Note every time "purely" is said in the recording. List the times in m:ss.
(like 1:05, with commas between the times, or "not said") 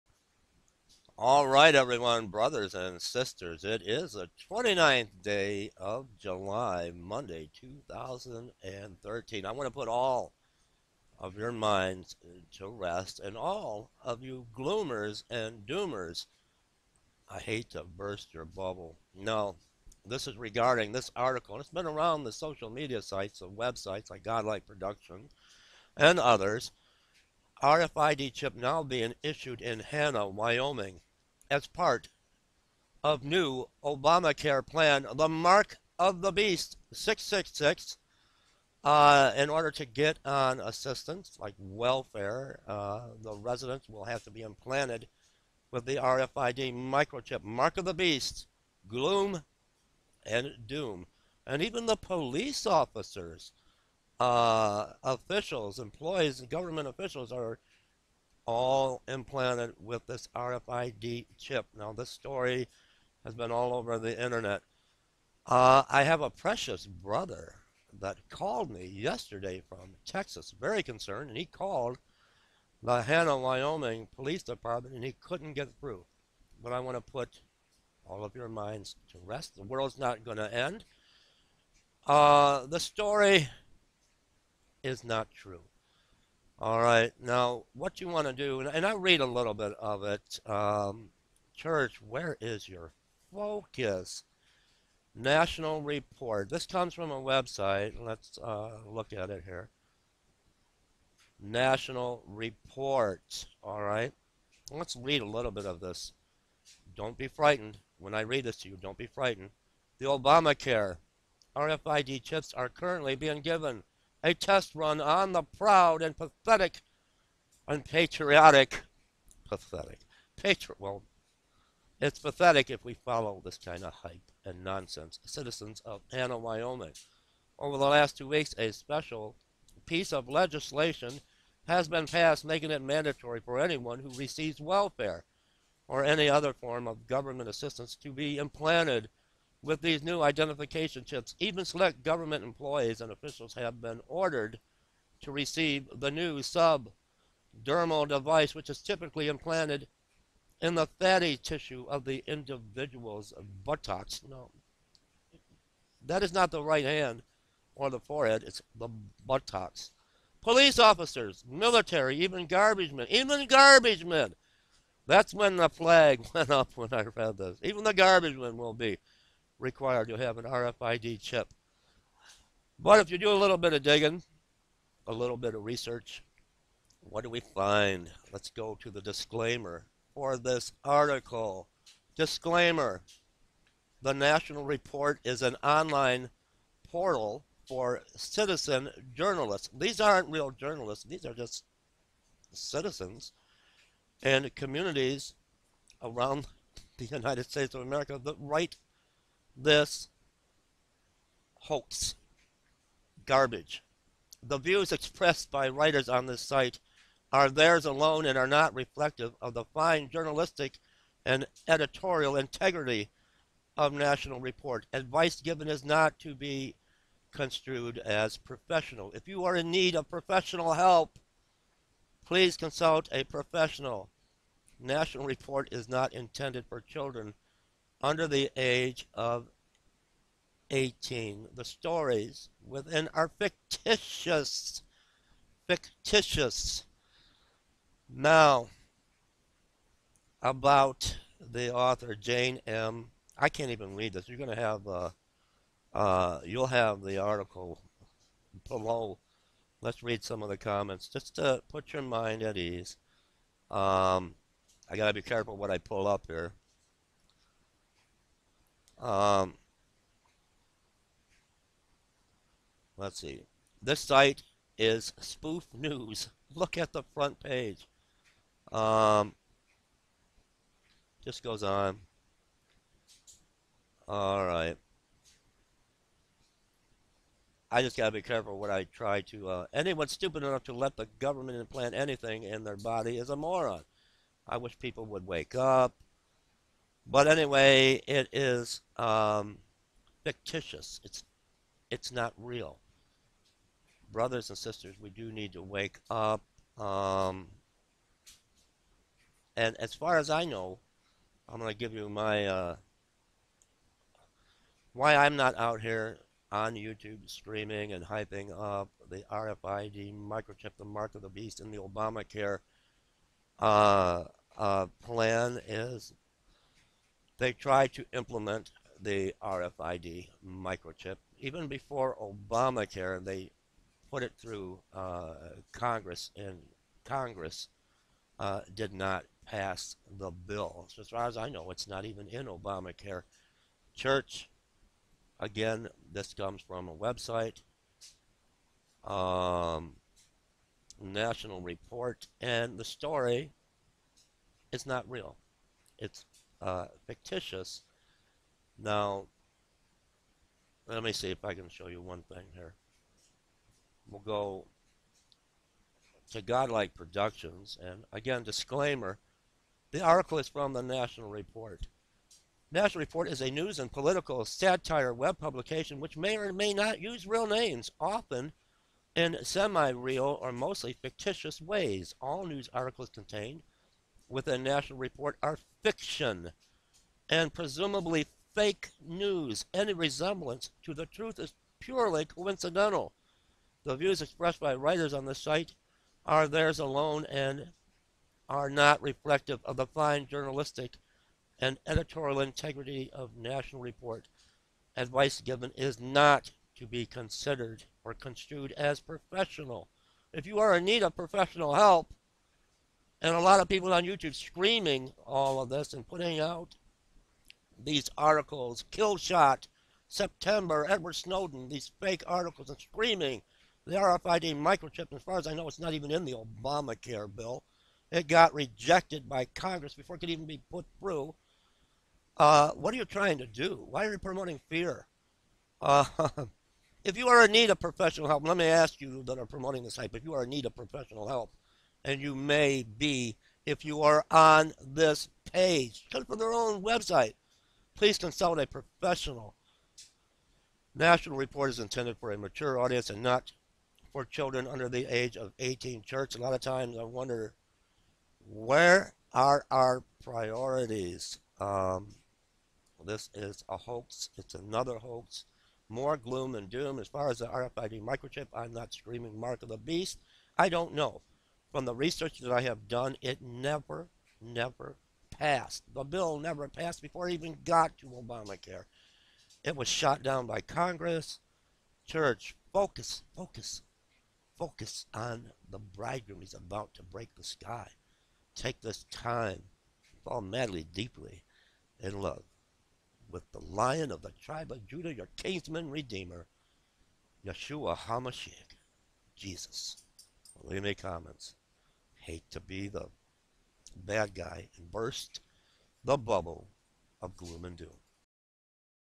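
6:21.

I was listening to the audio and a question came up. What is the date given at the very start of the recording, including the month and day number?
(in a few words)
July 29.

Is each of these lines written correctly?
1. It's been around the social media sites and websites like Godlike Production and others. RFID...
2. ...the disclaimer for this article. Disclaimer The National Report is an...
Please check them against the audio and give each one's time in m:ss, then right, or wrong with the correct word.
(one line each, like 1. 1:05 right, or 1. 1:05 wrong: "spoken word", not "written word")
1. 0:21 right
2. 2:58 right.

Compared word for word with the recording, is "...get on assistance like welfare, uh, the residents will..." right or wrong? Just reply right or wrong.
right.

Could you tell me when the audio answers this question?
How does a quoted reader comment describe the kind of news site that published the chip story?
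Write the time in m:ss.
4:25.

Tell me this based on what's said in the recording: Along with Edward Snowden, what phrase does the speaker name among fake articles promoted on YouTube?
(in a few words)
Kill Shot.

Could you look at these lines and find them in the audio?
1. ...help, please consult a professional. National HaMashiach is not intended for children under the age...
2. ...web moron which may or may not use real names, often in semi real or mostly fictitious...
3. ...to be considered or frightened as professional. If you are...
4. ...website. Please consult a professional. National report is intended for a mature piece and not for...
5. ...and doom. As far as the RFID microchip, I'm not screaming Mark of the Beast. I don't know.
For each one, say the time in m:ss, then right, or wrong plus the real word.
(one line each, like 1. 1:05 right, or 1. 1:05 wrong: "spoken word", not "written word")
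1. 3:40 wrong: "Report", not "HaMashiach"
2. 6:05 wrong: "publication", not "moron"
3. 6:36 wrong: "construed", not "frightened"
4. 7:16 wrong: "audience", not "piece"
5. 7:36 right.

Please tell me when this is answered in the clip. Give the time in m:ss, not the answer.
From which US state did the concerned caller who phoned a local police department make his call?
1:10.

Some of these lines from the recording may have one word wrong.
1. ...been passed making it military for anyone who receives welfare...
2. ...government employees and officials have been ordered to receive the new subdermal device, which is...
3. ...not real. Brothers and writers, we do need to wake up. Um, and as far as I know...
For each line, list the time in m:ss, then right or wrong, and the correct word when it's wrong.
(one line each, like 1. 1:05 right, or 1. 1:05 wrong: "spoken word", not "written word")
1. 2:11 wrong: "mandatory", not "military"
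2. 2:22 right
3. 4:52 wrong: "sisters", not "writers".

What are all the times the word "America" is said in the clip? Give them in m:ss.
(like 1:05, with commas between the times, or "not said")
3:17.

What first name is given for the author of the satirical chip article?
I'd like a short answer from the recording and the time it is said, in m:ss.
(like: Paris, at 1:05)
Jane, at 4:02.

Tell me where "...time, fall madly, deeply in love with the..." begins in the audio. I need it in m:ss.
7:59.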